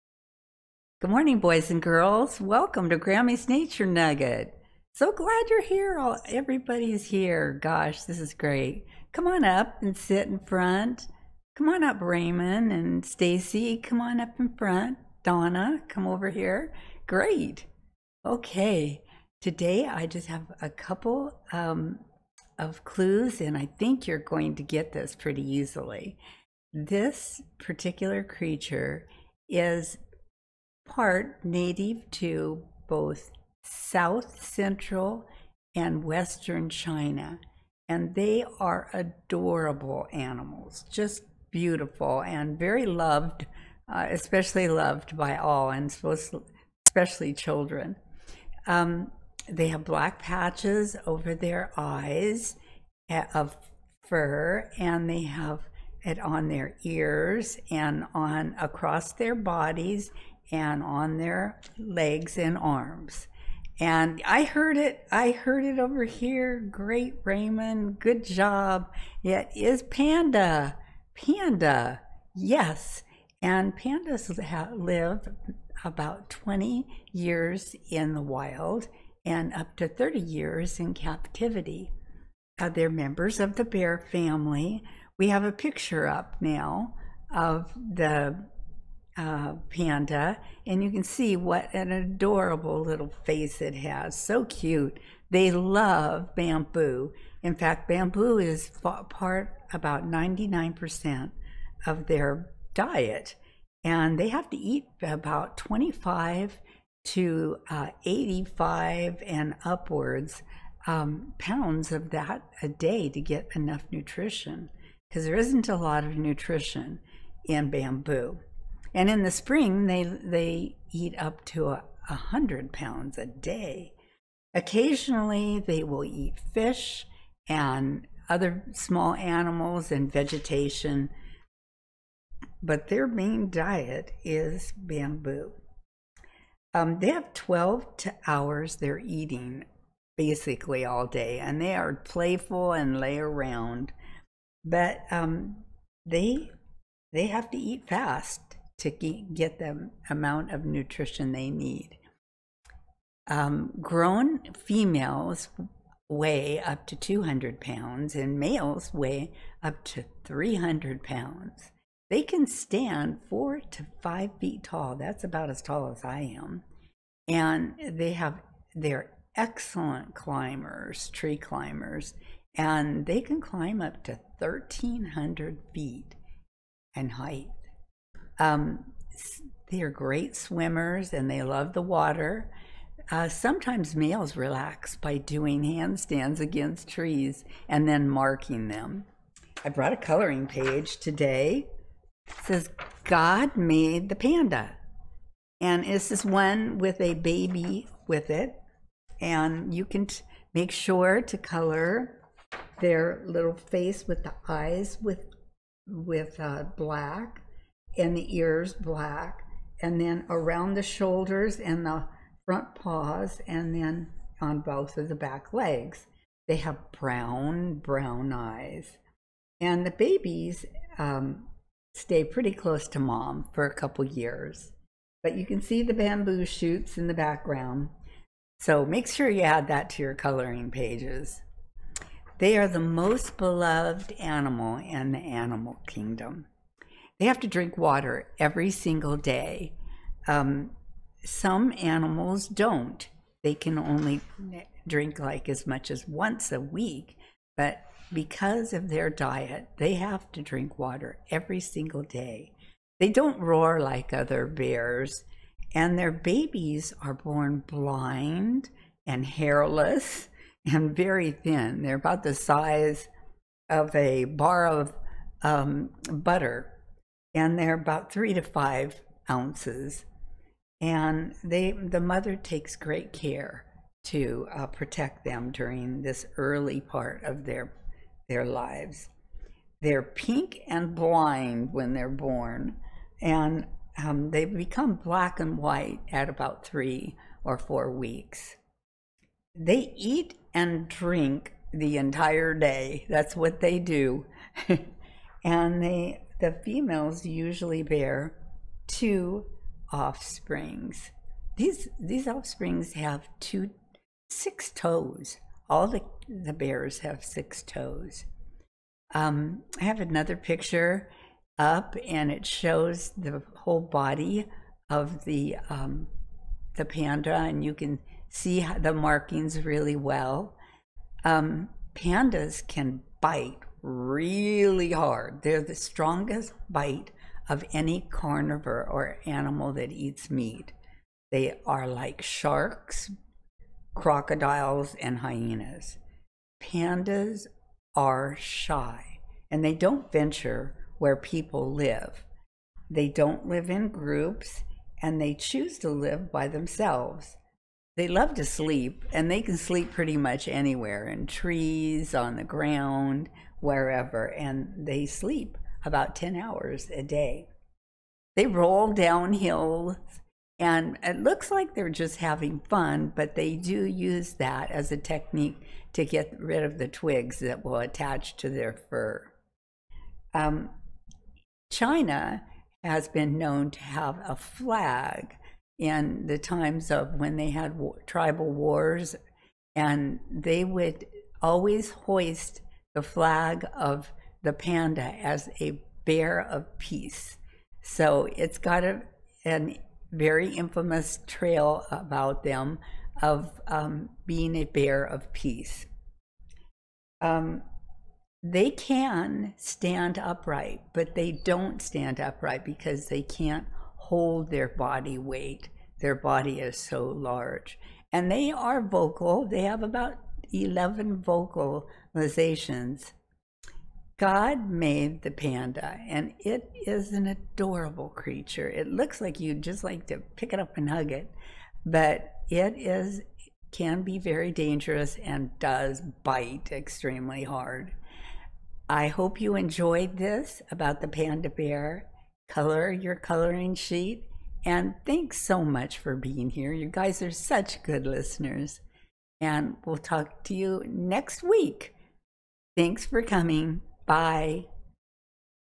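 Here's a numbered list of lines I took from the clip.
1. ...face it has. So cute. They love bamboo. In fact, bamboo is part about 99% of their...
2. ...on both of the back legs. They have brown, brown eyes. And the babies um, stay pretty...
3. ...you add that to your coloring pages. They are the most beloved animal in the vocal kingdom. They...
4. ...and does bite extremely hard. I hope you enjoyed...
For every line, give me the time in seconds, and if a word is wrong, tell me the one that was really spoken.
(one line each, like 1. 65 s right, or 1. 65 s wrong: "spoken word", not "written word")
1. 93 s right
2. 214 s right
3. 229 s wrong: "animal", not "vocal"
4. 425 s right.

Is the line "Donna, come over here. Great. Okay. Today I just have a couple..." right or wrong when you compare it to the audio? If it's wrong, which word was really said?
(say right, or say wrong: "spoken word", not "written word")
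right.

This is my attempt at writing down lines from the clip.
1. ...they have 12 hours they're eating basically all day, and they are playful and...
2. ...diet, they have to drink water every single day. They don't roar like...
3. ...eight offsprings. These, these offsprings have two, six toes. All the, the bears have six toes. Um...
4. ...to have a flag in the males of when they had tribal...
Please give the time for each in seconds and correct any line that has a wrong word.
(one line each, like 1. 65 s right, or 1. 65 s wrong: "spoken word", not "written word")
1. 136 s right
2. 249 s right
3. 298 s wrong: "two", not "eight"
4. 373 s wrong: "times", not "males".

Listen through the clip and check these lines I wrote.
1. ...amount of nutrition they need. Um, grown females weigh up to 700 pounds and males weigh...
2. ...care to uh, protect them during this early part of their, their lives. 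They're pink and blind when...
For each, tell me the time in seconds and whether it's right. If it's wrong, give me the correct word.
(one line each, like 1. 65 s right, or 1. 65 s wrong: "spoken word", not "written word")
1. 150 s wrong: "200", not "700"
2. 273 s right.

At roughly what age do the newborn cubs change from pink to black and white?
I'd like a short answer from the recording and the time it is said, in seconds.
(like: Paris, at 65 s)
3 or 4 weeks, at 286 s.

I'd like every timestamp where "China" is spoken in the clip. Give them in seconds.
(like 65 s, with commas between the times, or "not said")
36 s, 371 s.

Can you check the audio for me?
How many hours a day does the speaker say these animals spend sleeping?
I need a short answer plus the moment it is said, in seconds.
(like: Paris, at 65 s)
10 hours, at 356 s.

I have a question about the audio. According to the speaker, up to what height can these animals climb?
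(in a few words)
1,300 feet.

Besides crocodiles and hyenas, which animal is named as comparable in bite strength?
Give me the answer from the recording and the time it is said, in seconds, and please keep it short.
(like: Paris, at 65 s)
Sharks, at 332 s.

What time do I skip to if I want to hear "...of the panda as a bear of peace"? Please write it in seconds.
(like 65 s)
383 s.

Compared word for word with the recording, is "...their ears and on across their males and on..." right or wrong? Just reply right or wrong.
wrong.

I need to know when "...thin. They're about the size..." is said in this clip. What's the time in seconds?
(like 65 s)
261 s.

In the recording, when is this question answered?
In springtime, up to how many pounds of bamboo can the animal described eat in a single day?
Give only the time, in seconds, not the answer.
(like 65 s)
122 s.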